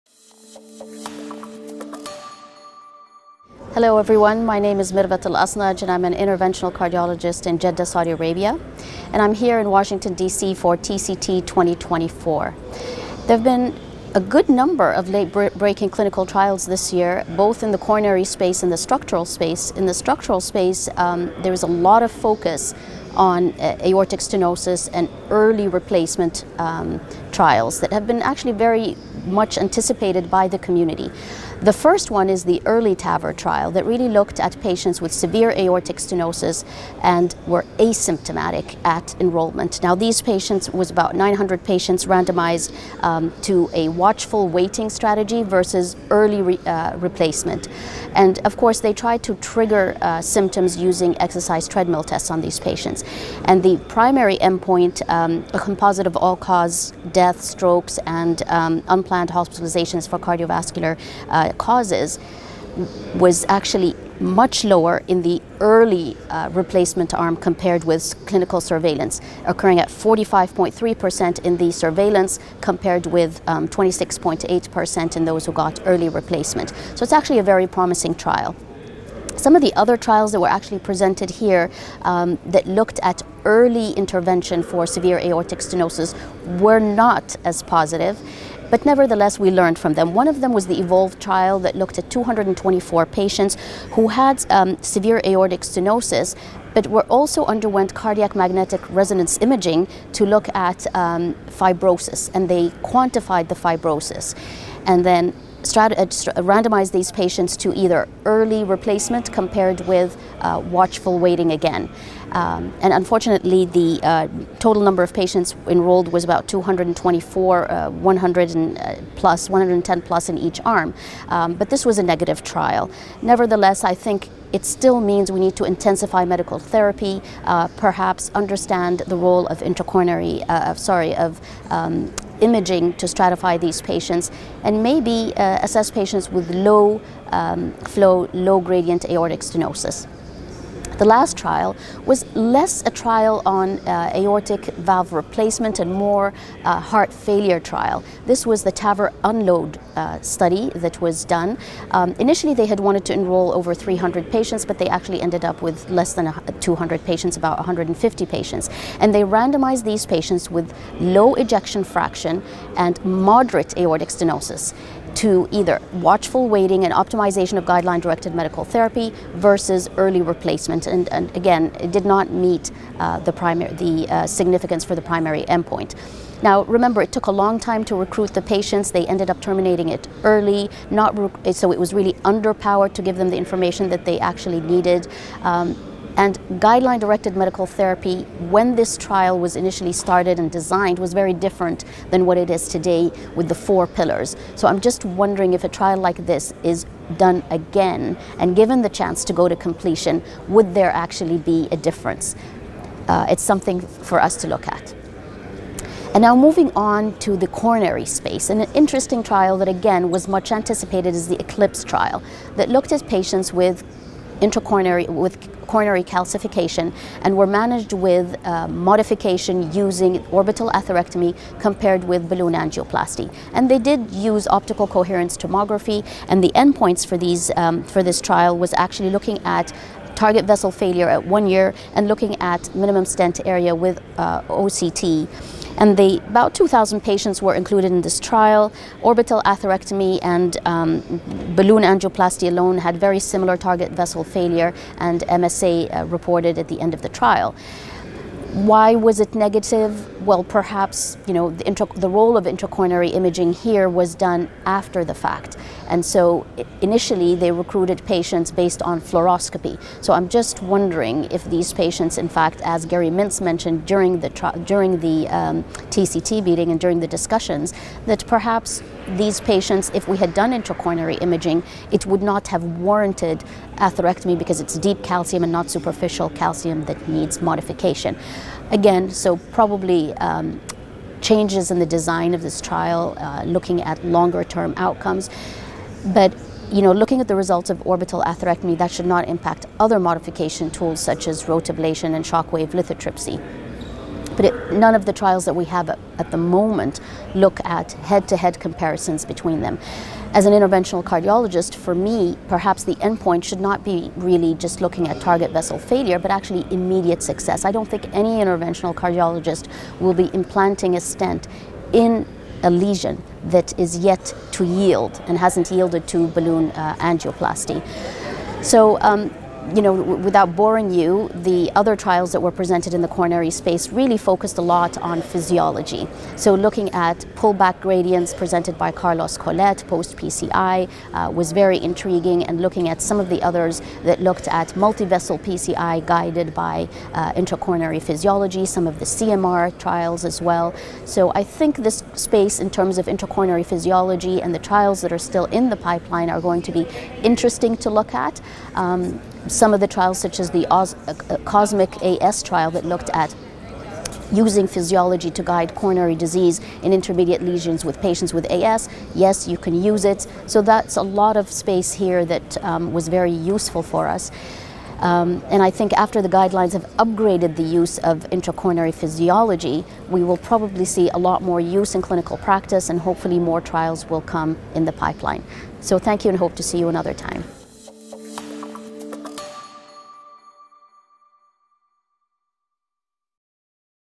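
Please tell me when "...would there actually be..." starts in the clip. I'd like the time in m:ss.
3:20.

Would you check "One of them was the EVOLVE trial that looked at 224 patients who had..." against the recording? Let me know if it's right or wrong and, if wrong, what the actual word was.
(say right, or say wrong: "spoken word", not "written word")
right.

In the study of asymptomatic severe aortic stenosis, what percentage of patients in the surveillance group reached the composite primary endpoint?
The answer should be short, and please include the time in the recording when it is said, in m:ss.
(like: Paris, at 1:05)
45.3%, at 1:09.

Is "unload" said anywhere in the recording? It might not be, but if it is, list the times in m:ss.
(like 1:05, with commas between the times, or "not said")
2:29.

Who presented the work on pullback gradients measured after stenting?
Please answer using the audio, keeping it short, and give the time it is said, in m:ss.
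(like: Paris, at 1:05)
Carlos Collet, at 5:28.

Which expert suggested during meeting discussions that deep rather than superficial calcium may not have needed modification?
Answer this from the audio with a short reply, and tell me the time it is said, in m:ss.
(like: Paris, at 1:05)
Gary Mintz, at 4:22.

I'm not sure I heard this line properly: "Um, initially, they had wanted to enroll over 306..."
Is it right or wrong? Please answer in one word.
wrong.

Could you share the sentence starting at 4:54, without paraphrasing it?
But it, none of the trials that we have at, at the moment look at head to head comparisons between them.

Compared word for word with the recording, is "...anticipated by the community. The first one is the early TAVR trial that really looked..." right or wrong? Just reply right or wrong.
right.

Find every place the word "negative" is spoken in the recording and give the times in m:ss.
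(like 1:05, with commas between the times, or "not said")
2:02, 4:09.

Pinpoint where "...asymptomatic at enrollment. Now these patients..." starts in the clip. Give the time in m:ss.
0:37.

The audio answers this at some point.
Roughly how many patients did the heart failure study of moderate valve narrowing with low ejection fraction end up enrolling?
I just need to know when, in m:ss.
2:37.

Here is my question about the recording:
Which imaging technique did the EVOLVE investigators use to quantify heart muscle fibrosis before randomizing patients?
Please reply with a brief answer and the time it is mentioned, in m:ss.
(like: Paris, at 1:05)
Cardiac magnetic resonance imaging, at 1:37.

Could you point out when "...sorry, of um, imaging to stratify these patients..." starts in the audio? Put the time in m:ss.
2:10.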